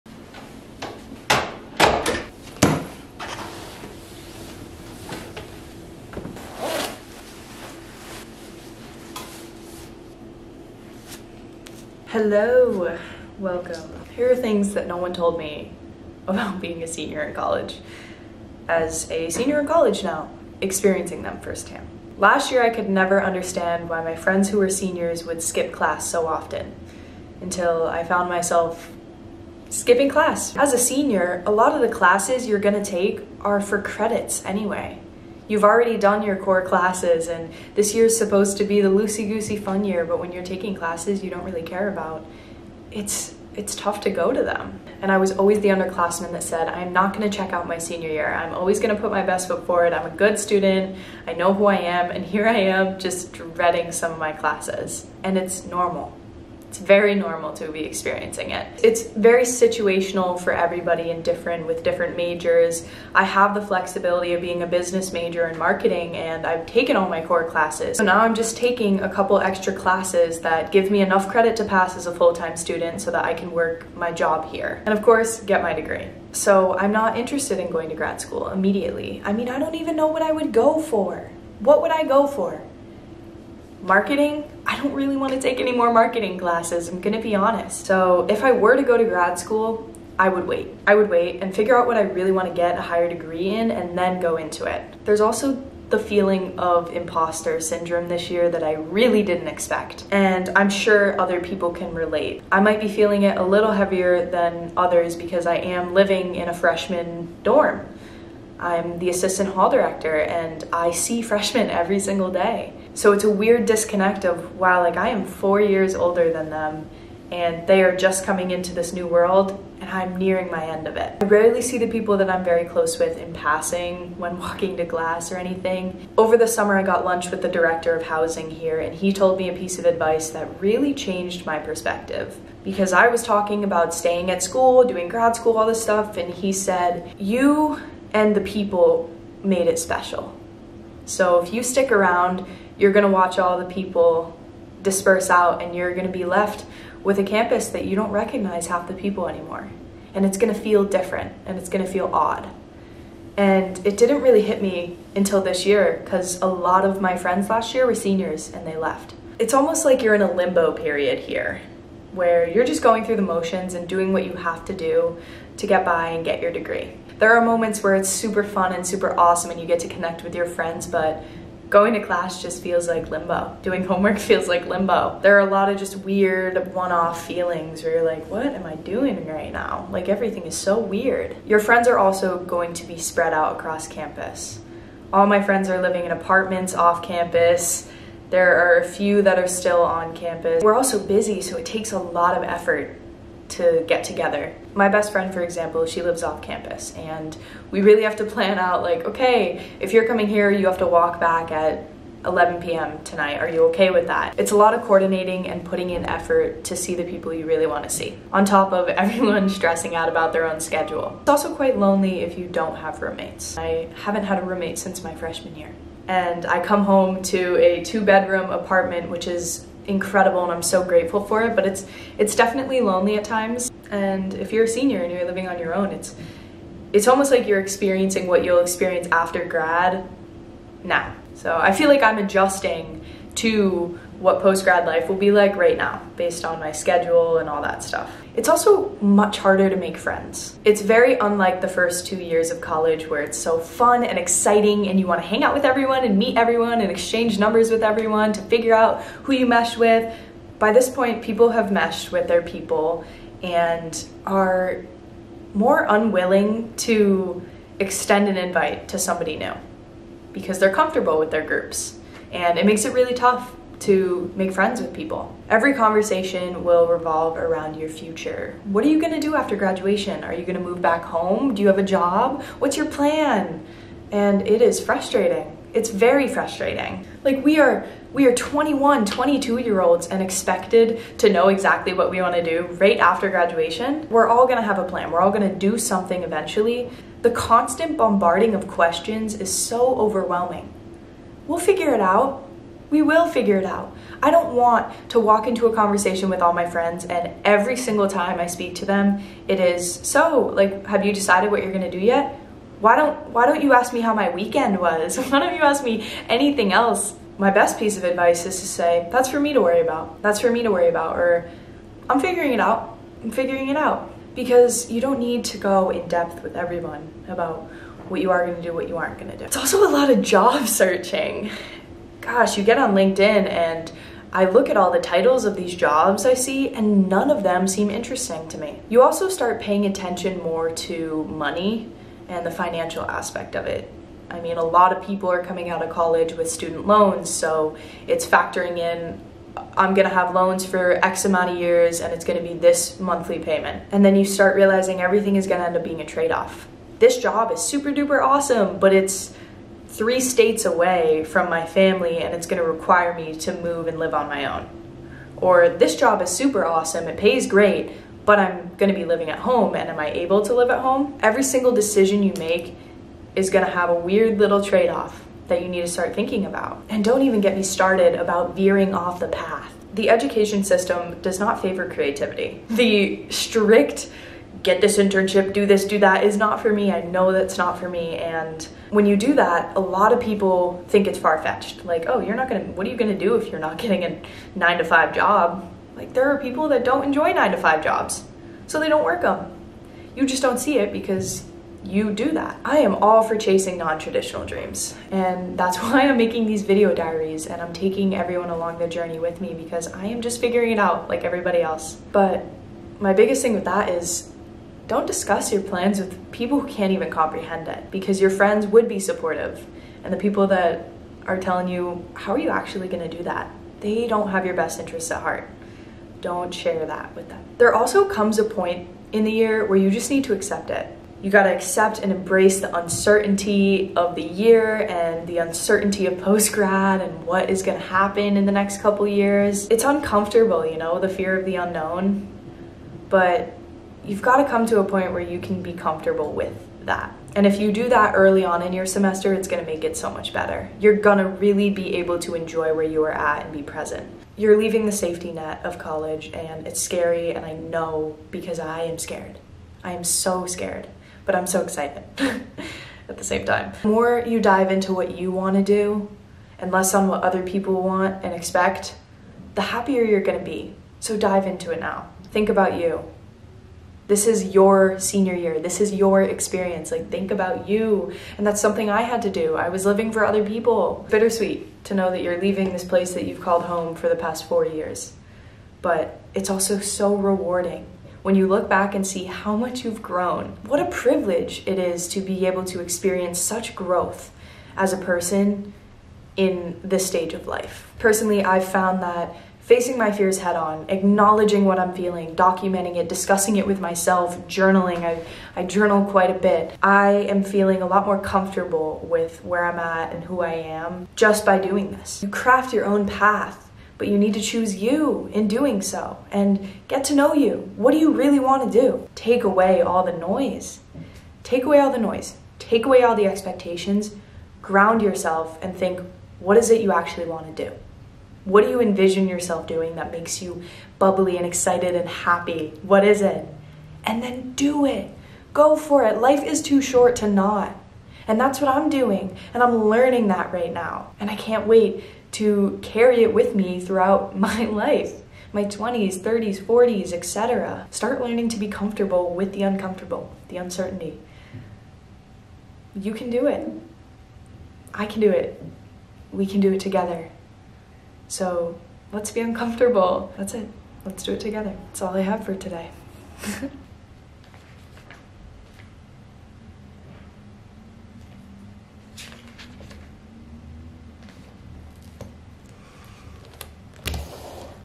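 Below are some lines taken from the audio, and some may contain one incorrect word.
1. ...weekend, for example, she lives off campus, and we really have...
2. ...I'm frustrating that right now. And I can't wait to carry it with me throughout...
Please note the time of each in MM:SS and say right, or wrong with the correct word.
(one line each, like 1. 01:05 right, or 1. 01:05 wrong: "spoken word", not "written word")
1. 03:15 wrong: "friend", not "weekend"
2. 08:49 wrong: "learning", not "frustrating".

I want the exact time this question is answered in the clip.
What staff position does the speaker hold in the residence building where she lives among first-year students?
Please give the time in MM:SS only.
01:49.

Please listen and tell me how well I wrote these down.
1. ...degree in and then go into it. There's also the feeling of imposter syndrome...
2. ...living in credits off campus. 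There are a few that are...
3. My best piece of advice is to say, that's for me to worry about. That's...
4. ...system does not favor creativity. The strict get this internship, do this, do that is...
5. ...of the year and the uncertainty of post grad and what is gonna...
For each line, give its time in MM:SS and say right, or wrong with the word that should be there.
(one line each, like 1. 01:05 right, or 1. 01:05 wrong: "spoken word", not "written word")
1. 01:33 right
2. 03:05 wrong: "apartments", not "credits"
3. 05:07 right
4. 06:10 right
5. 07:03 right.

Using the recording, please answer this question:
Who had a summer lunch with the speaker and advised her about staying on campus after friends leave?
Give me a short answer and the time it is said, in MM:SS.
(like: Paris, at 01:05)
Director of housing, at 02:07.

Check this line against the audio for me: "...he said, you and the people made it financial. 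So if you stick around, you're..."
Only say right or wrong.
wrong.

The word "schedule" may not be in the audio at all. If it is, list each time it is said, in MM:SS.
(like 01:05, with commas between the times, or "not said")
03:30, 03:56.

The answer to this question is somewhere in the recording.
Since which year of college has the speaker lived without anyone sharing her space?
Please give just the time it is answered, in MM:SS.
03:35.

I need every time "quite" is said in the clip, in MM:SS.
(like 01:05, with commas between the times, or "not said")
03:31, 08:16.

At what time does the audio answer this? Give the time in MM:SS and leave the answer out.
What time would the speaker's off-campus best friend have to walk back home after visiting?
03:22.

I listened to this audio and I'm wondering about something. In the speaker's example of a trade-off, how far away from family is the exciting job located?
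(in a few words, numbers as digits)
Three states.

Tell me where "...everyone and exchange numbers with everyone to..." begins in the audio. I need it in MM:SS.
04:06.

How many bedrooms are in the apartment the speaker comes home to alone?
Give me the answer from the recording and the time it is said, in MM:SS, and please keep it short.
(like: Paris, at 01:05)
2, at 03:37.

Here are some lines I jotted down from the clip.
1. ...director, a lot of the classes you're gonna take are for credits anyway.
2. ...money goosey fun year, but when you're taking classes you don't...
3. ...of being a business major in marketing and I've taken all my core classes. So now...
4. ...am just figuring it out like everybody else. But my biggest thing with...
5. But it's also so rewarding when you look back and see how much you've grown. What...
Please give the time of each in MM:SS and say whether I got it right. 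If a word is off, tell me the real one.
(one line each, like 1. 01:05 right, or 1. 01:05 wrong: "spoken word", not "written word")
1. 00:30 wrong: "senior", not "director"
2. 00:38 wrong: "loosey", not "money"
3. 01:04 right
4. 06:40 right
5. 07:55 right.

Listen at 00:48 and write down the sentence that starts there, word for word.
I'm always gonna put my best foot forward.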